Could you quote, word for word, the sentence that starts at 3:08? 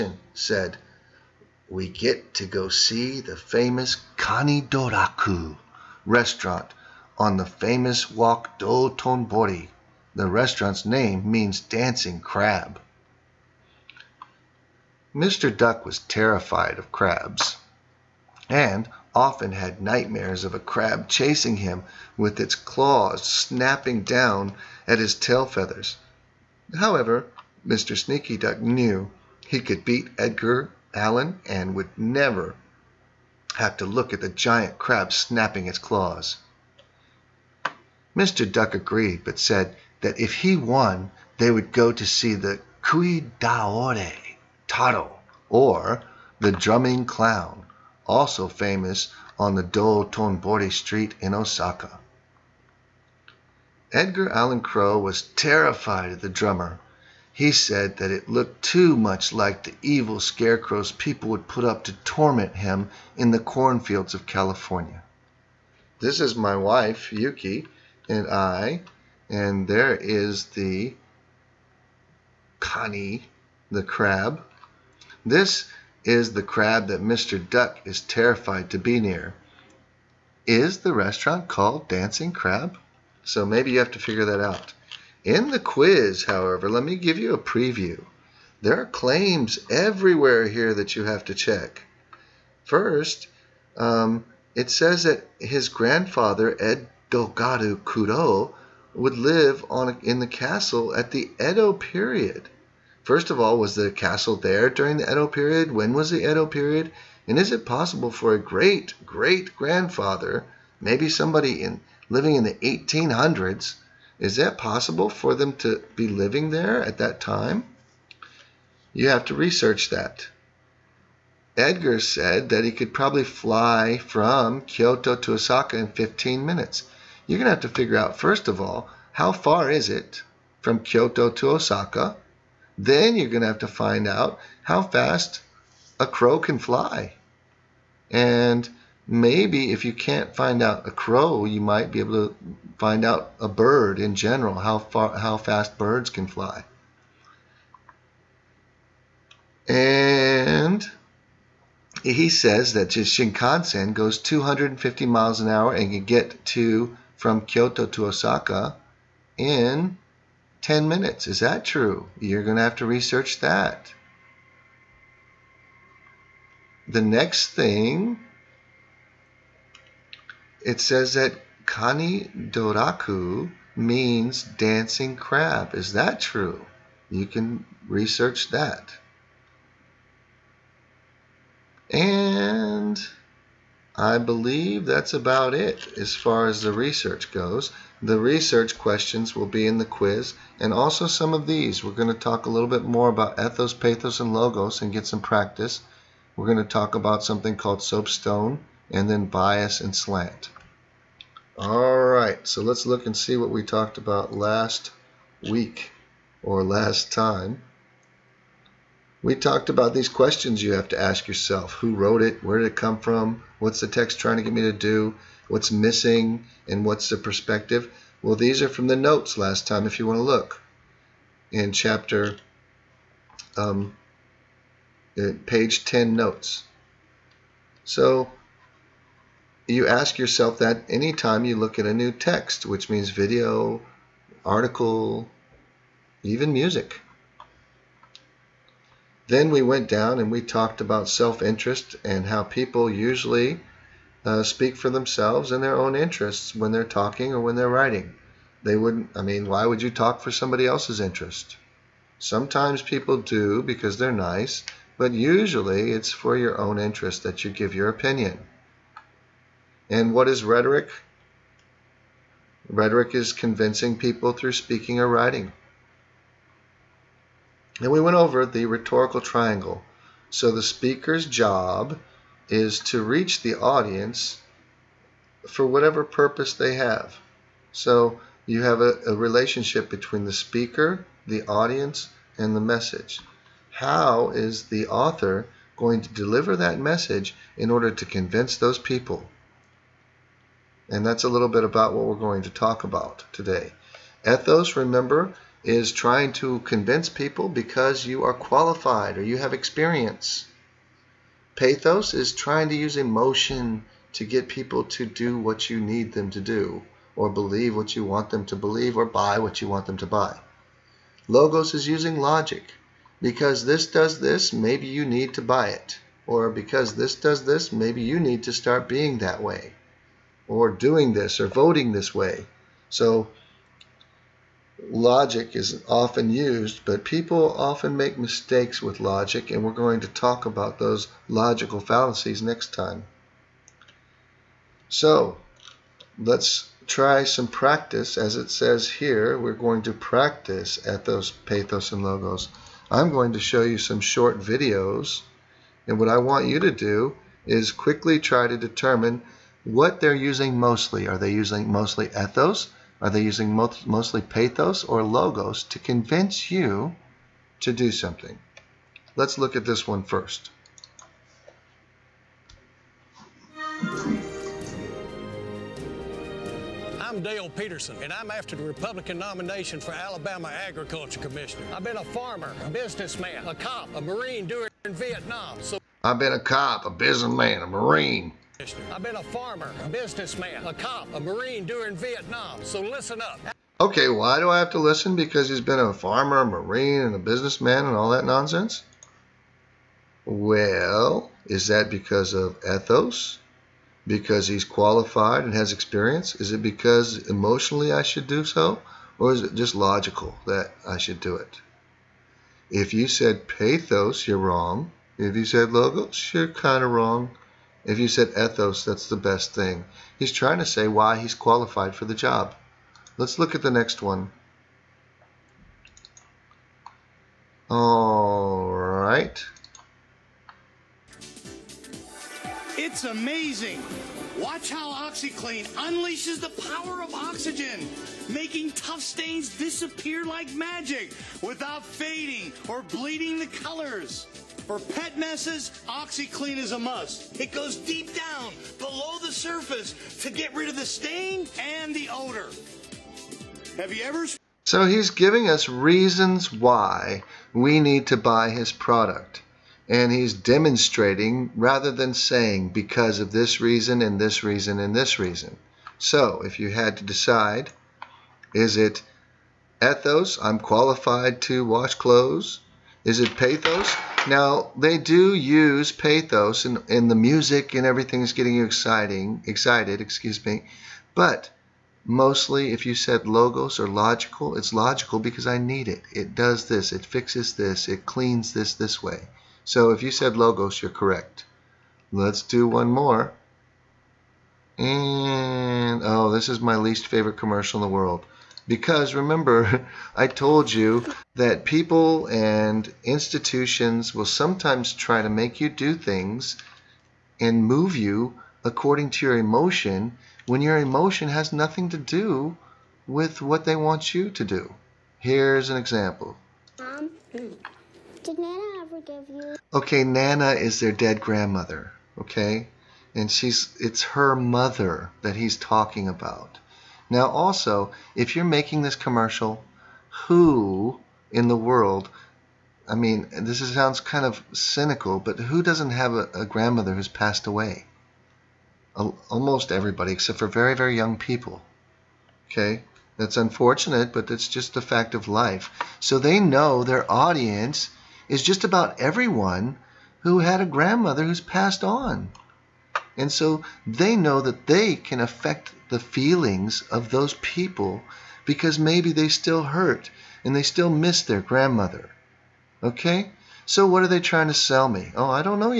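The research questions will be in the quiz, and also some of these.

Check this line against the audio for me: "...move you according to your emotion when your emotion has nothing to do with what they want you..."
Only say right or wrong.
right.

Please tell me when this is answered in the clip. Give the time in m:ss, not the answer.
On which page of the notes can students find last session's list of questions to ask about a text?
3:45.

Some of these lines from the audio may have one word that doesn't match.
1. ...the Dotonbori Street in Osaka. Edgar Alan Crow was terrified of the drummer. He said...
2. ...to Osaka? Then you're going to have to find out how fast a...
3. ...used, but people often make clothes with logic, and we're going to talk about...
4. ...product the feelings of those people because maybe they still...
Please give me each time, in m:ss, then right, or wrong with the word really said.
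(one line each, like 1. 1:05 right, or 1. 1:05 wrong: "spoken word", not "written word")
1. 0:49 right
2. 2:11 right
3. 5:26 wrong: "mistakes", not "clothes"
4. 9:05 wrong: "affect", not "product".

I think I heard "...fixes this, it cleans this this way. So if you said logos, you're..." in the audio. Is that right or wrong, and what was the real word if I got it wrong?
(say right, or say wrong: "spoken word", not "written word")
right.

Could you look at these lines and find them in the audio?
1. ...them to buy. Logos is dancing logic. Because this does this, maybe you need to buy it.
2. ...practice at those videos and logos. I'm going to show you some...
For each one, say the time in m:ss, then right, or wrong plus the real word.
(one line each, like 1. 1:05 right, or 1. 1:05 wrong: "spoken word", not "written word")
1. 5:09 wrong: "using", not "dancing"
2. 5:39 wrong: "pathos", not "videos".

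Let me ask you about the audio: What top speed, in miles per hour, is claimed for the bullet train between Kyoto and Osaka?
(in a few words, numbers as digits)
250 miles an hour.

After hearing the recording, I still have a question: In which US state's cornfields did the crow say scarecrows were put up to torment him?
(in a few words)
California.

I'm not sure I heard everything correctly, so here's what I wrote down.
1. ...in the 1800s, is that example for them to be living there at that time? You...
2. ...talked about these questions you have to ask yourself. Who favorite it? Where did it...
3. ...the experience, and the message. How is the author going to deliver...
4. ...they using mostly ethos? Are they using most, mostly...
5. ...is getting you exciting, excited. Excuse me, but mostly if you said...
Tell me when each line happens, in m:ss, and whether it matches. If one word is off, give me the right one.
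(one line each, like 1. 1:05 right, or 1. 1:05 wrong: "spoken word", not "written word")
1. 1:52 wrong: "possible", not "example"
2. 3:29 wrong: "wrote", not "favorite"
3. 4:41 wrong: "audience", not "experience"
4. 5:51 right
5. 7:48 right.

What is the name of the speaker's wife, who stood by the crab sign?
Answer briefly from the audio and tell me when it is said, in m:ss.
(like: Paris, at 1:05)
Yuki, at 1:07.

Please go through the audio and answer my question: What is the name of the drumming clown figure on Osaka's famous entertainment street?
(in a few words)
Cui Daore Taro.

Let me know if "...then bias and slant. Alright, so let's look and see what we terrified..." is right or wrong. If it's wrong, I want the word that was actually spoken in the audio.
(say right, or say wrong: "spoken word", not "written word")
wrong: "talked", not "terrified".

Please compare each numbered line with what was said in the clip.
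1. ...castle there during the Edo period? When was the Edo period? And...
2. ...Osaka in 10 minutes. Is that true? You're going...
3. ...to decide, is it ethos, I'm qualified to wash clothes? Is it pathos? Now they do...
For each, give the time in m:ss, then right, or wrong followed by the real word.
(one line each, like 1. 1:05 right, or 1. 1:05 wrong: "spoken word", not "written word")
1. 1:43 right
2. 2:38 right
3. 7:36 right.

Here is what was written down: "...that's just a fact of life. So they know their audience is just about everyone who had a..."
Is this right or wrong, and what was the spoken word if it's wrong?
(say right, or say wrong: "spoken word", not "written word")
right.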